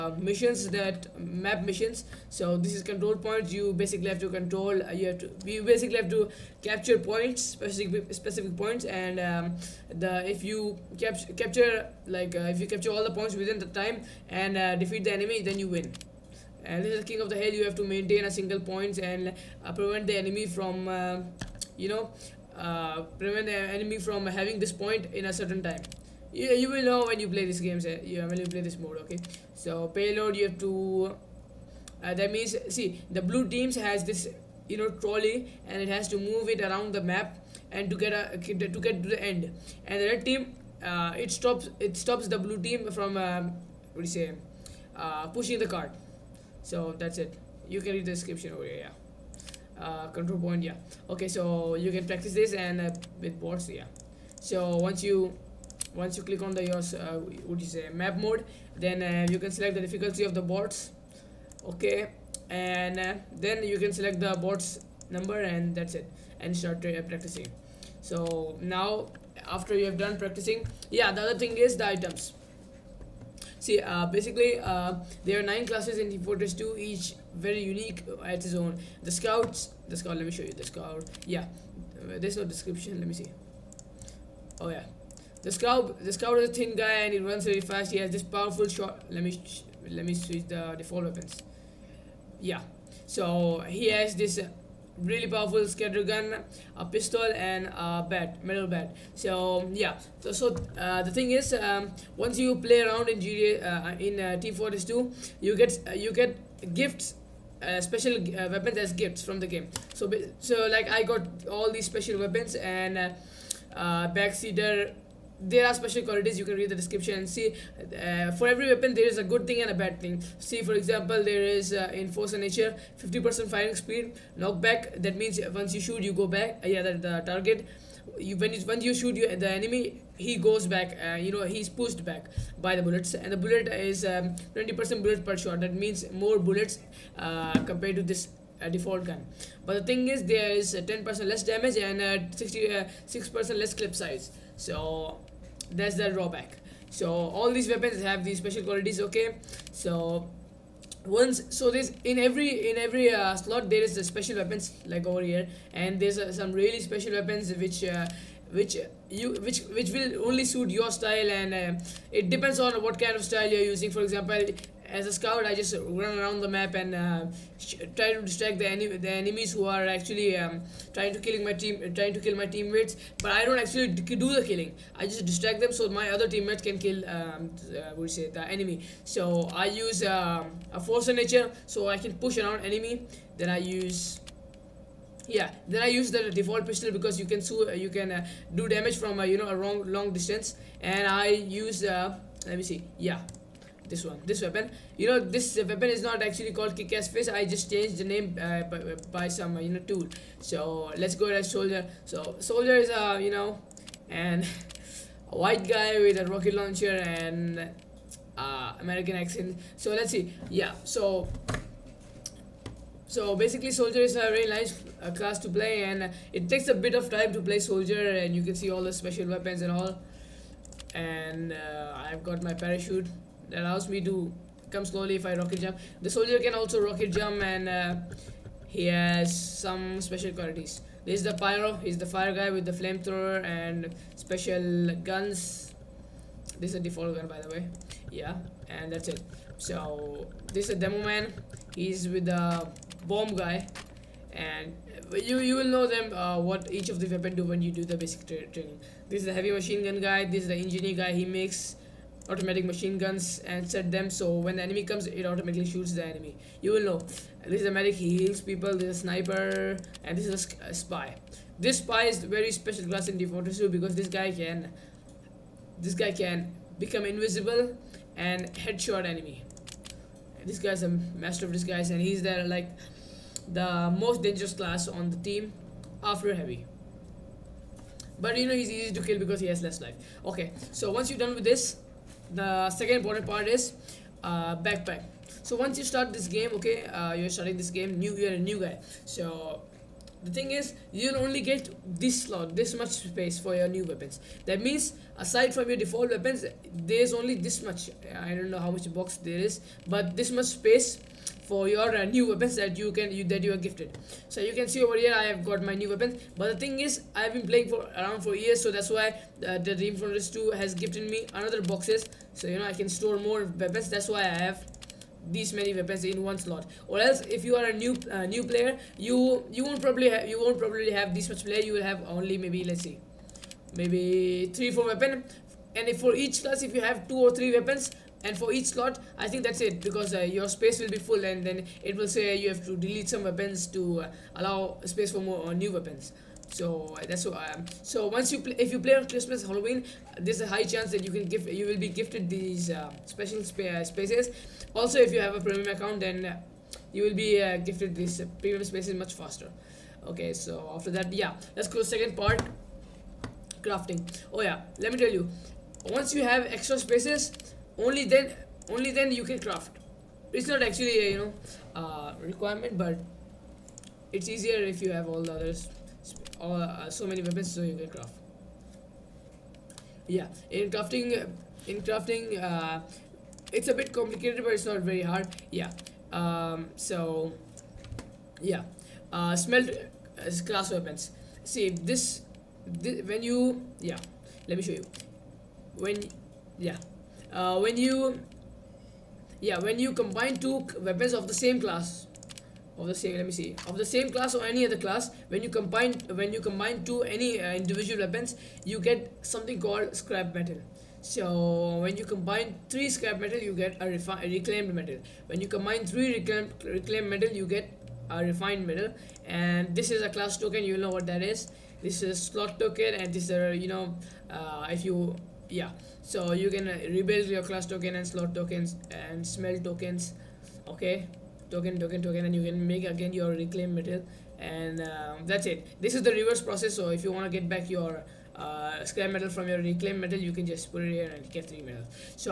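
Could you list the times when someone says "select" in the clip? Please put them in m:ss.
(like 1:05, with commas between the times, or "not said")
0:59, 1:03.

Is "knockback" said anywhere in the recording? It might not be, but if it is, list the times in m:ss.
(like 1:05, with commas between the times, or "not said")
2:04.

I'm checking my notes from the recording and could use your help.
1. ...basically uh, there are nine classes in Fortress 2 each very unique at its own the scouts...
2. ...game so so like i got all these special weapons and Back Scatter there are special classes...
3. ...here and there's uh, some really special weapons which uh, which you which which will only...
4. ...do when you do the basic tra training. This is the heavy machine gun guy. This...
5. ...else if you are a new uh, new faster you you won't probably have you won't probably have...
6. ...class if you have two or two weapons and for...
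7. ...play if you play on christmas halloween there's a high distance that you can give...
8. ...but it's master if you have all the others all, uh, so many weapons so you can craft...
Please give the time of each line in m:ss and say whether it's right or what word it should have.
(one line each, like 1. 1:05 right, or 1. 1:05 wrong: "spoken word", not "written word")
1. 1:14 right
2. 1:49 wrong: "qualities", not "classes"
3. 2:35 right
4. 4:07 right
5. 5:17 wrong: "player", not "faster"
6. 5:26 wrong: "three", not "two"
7. 5:38 wrong: "chance", not "distance"
8. 6:02 wrong: "easier", not "master".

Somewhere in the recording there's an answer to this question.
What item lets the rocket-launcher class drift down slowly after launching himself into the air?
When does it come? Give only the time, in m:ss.
3:42.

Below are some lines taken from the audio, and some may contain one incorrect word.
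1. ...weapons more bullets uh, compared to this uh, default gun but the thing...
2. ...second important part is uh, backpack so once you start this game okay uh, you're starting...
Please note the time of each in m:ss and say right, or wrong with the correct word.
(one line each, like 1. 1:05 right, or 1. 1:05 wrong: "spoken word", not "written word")
1. 2:15 wrong: "means", not "weapons"
2. 4:42 right.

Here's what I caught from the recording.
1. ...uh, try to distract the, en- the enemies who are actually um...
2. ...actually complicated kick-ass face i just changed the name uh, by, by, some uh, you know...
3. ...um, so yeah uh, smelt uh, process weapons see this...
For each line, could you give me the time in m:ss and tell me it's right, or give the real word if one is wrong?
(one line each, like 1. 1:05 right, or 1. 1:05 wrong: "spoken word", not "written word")
1. 2:46 right
2. 3:16 wrong: "called", not "complicated"
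3. 6:16 wrong: "class", not "process".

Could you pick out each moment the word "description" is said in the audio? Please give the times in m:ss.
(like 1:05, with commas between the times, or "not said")
0:48, 1:22, 1:56.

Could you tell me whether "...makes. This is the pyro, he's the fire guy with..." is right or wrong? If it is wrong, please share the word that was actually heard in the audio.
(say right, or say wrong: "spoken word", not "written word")
wrong: "qualities", not "makes".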